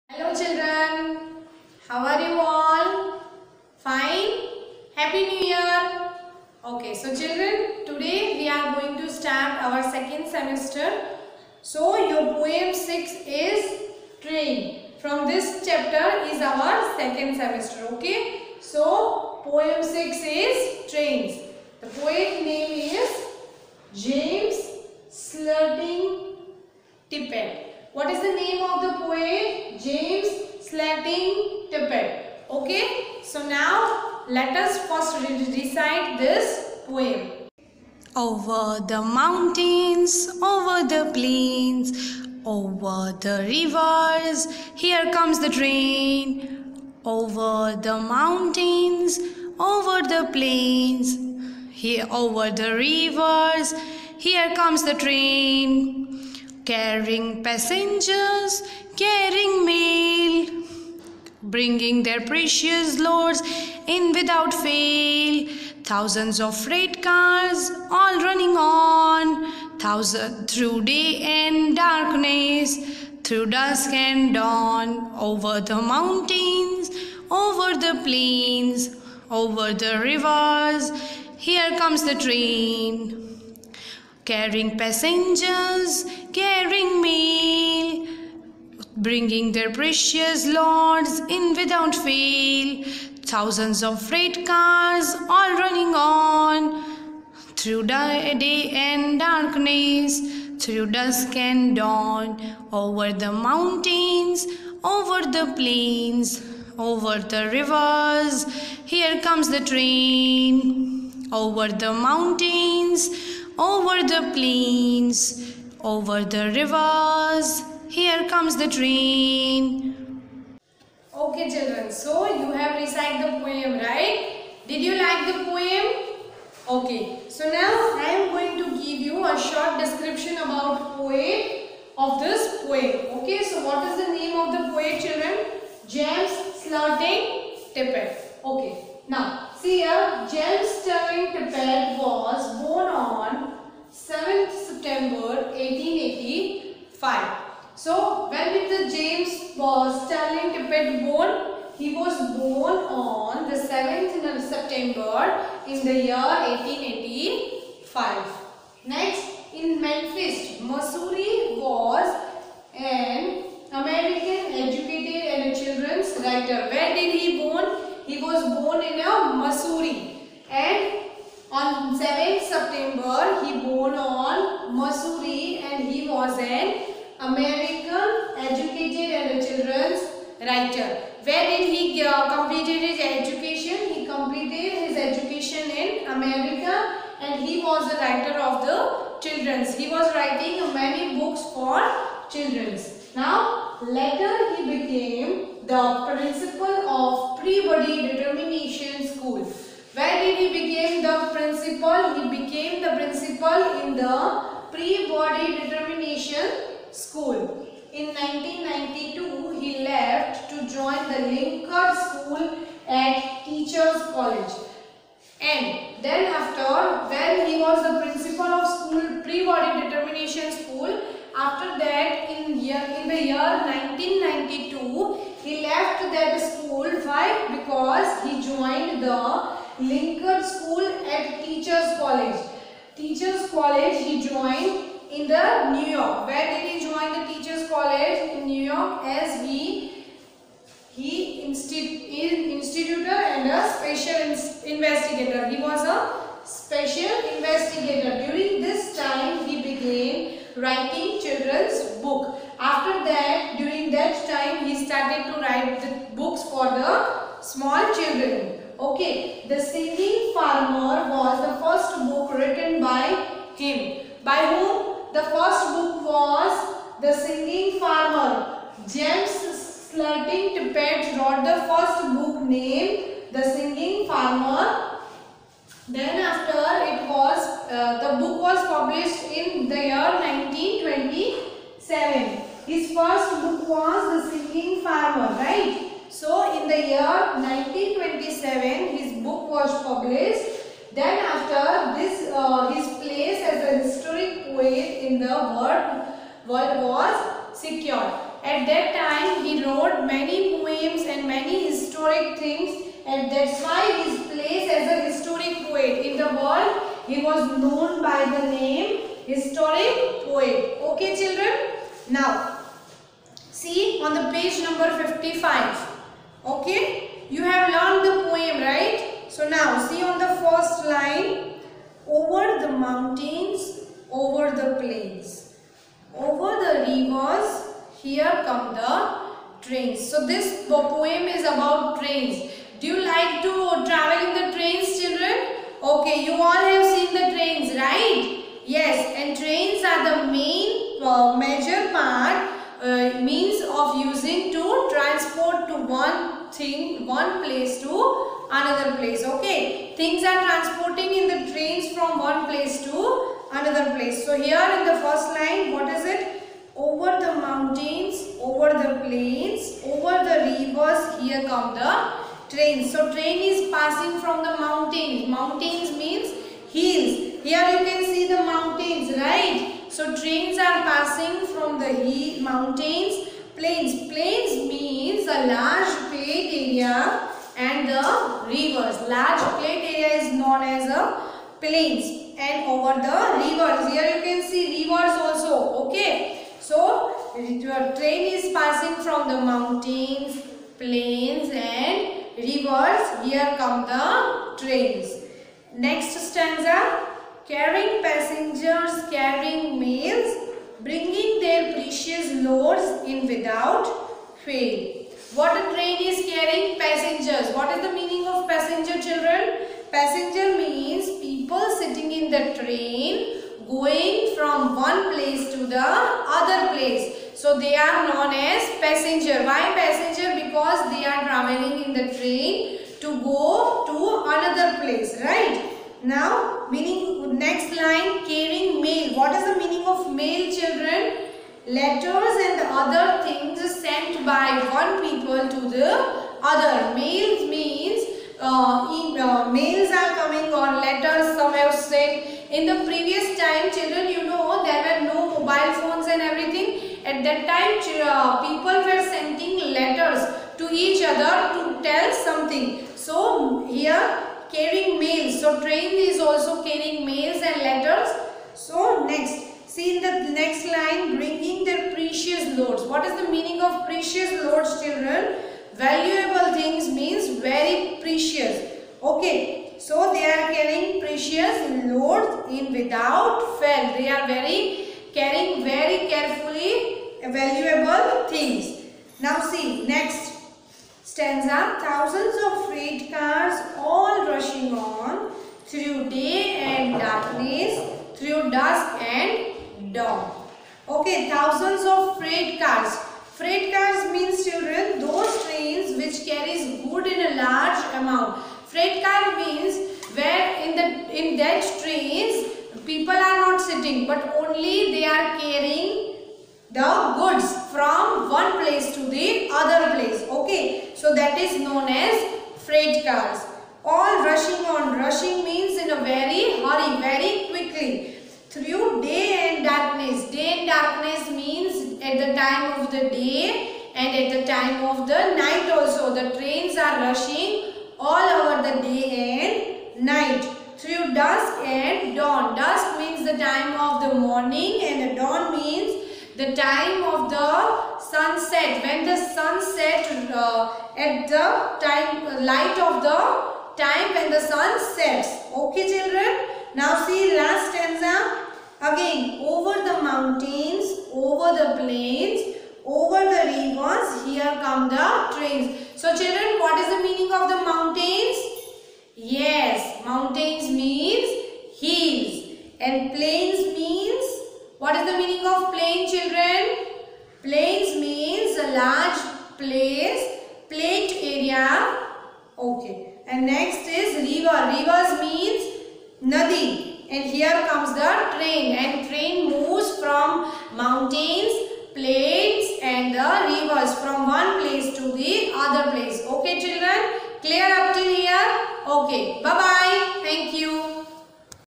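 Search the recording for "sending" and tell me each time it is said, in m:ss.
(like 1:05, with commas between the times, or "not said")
7:29.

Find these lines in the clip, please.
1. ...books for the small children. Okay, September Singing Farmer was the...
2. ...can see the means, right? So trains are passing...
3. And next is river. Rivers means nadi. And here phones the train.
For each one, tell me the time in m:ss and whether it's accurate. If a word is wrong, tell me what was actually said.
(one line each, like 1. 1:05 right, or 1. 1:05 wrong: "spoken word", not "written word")
1. 4:16 wrong: "The", not "September"
2. 6:07 wrong: "mountains", not "means"
3. 9:33 wrong: "comes", not "phones".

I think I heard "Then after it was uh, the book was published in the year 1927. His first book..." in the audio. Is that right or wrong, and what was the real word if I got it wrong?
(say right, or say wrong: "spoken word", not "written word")
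right.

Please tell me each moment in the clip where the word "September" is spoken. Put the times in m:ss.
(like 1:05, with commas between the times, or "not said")
2:24, 2:34, 2:52.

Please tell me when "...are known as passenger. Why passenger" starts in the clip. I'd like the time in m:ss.
6:57.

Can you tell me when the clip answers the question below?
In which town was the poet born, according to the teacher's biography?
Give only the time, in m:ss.
2:39.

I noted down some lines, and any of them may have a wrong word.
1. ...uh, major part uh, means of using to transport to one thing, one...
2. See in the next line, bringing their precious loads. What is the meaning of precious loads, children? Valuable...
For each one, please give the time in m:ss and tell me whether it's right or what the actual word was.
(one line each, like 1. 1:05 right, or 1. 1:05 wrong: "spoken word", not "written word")
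1. 5:41 right
2. 7:39 right.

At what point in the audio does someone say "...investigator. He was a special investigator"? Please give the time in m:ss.
4:04.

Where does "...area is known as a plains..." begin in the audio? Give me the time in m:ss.
6:19.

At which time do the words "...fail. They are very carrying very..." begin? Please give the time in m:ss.
7:53.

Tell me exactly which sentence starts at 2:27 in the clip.
So when did the James uh, Sterling Tippett born?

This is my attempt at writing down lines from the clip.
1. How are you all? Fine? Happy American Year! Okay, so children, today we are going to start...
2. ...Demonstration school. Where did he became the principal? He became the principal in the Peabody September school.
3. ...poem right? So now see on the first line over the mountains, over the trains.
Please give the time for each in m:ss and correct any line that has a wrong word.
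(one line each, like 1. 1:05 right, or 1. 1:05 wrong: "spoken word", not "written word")
1. 0:01 wrong: "New", not "American"
2. 3:18 wrong: "Demonstration", not "September"
3. 5:18 wrong: "plains", not "trains".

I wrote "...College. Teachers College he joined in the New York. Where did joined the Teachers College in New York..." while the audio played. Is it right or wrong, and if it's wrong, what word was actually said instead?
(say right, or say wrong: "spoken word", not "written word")
right.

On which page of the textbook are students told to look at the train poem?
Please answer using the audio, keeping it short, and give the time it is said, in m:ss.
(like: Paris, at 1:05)
55, at 5:14.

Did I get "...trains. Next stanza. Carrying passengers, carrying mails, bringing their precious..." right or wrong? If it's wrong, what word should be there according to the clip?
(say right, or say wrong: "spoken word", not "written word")
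right.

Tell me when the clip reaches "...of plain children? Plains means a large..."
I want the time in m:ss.
9:25.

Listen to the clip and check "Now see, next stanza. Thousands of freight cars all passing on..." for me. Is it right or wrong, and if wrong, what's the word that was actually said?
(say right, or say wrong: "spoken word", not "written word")
wrong: "rushing", not "passing".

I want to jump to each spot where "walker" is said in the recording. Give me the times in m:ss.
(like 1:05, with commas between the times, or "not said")
not said.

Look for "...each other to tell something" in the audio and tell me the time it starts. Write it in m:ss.
7:30.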